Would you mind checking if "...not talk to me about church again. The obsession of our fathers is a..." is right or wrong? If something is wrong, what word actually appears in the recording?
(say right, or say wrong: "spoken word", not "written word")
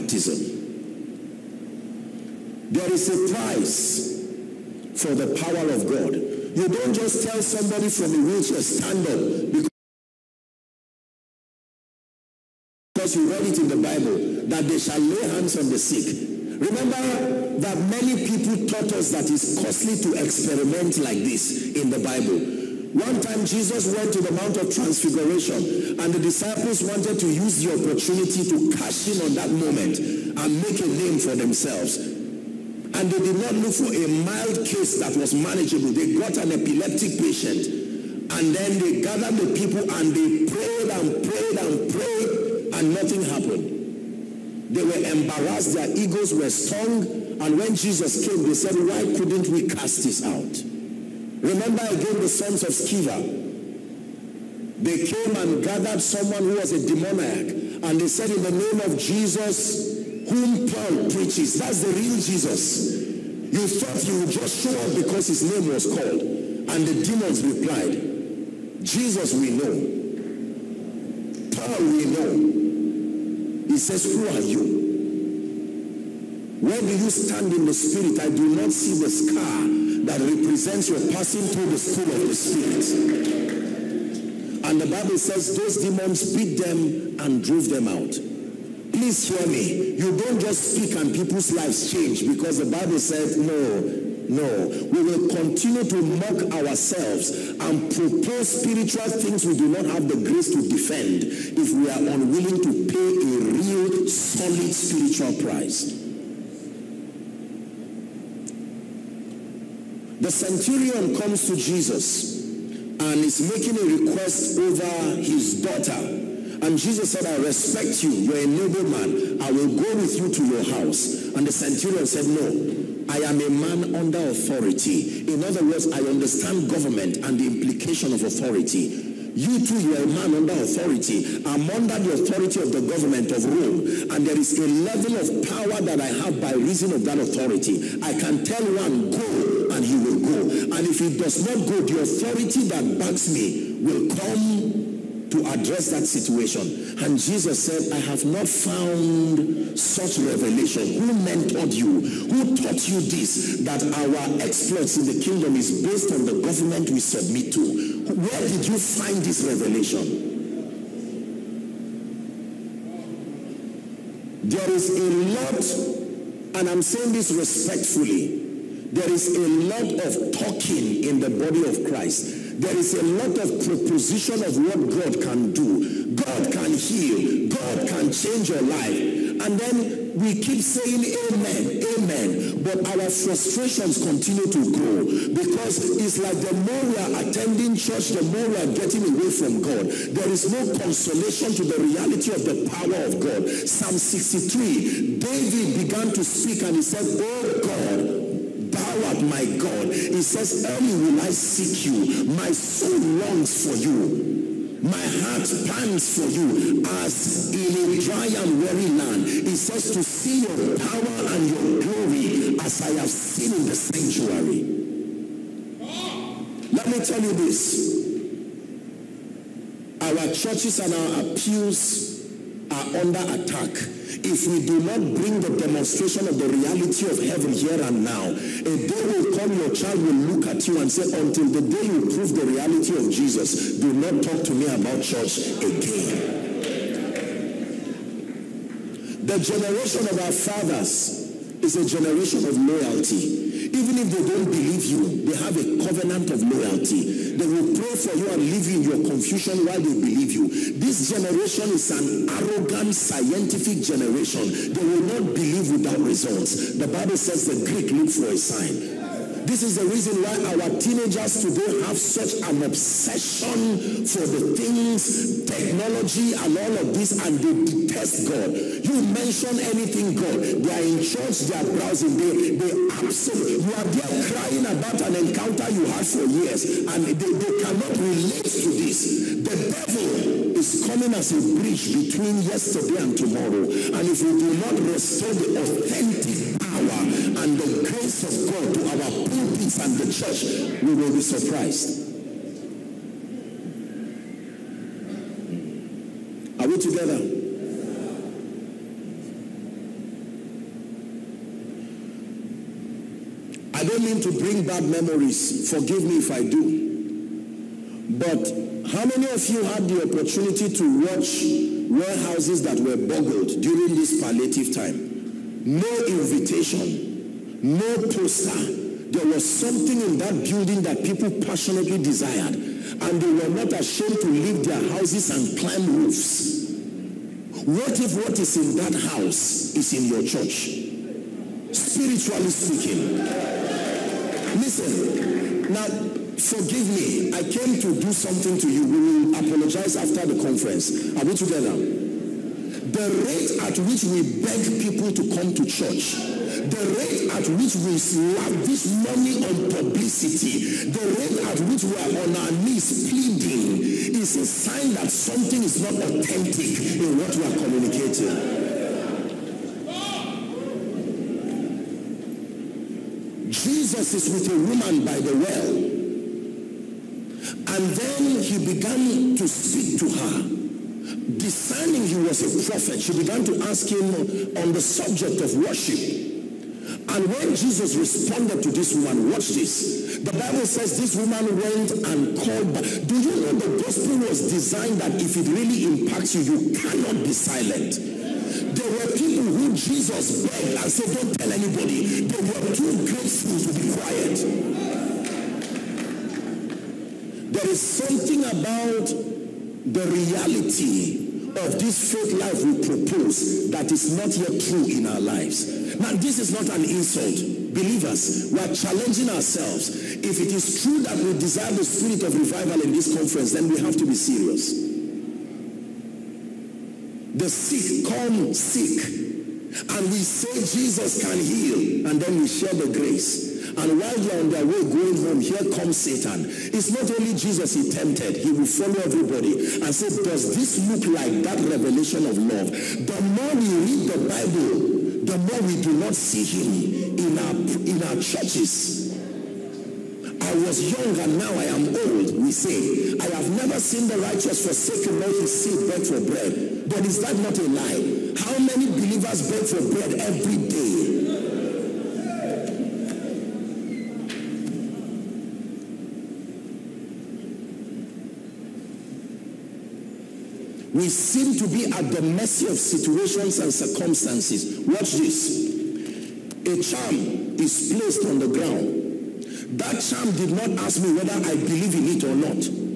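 wrong: "generation", not "obsession".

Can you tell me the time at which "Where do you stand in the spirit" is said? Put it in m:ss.
1:16.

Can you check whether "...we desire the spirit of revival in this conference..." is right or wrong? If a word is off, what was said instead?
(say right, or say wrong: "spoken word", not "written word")
right.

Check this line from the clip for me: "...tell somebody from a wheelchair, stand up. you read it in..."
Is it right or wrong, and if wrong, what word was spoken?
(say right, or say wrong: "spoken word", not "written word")
right.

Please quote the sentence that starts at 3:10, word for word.
There is no consolation to the reality of the power of God.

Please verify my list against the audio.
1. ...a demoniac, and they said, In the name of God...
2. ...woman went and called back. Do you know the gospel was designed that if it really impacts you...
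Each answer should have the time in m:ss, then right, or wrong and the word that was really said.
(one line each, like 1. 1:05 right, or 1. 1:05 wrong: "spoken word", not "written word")
1. 0:56 wrong: "Jesus", not "God"
2. 6:21 right.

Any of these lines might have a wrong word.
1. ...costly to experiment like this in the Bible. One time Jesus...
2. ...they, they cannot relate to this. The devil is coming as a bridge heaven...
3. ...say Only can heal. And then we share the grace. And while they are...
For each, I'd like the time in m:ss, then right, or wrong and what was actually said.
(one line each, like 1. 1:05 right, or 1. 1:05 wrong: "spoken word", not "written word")
1. 0:19 right
2. 4:37 wrong: "between", not "heaven"
3. 7:00 wrong: "Jesus", not "Only".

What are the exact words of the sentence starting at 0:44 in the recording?
They were embarrassed, their egos were strong, and when Jesus came, they said, Why couldn't we cast this out?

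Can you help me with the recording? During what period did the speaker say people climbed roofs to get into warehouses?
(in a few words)
palliative time.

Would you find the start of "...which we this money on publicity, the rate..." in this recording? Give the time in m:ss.
5:47.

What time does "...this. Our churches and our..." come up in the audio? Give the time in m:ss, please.
3:37.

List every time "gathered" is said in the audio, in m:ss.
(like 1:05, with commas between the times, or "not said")
0:39, 0:55.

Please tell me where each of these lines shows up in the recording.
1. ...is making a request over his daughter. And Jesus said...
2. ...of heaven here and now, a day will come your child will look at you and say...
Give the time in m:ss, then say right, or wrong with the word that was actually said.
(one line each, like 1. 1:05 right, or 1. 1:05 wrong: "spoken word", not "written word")
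1. 1:53 right
2. 3:47 right.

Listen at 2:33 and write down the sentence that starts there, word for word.
That our exploits in the kingdom is based on the government we submit to.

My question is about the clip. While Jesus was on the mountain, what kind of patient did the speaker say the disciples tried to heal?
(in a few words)
epileptic patient.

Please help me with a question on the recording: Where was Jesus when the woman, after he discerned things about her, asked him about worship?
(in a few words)
by the well.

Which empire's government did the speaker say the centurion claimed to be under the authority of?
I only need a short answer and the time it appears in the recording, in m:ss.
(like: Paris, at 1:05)
Rome, at 2:13.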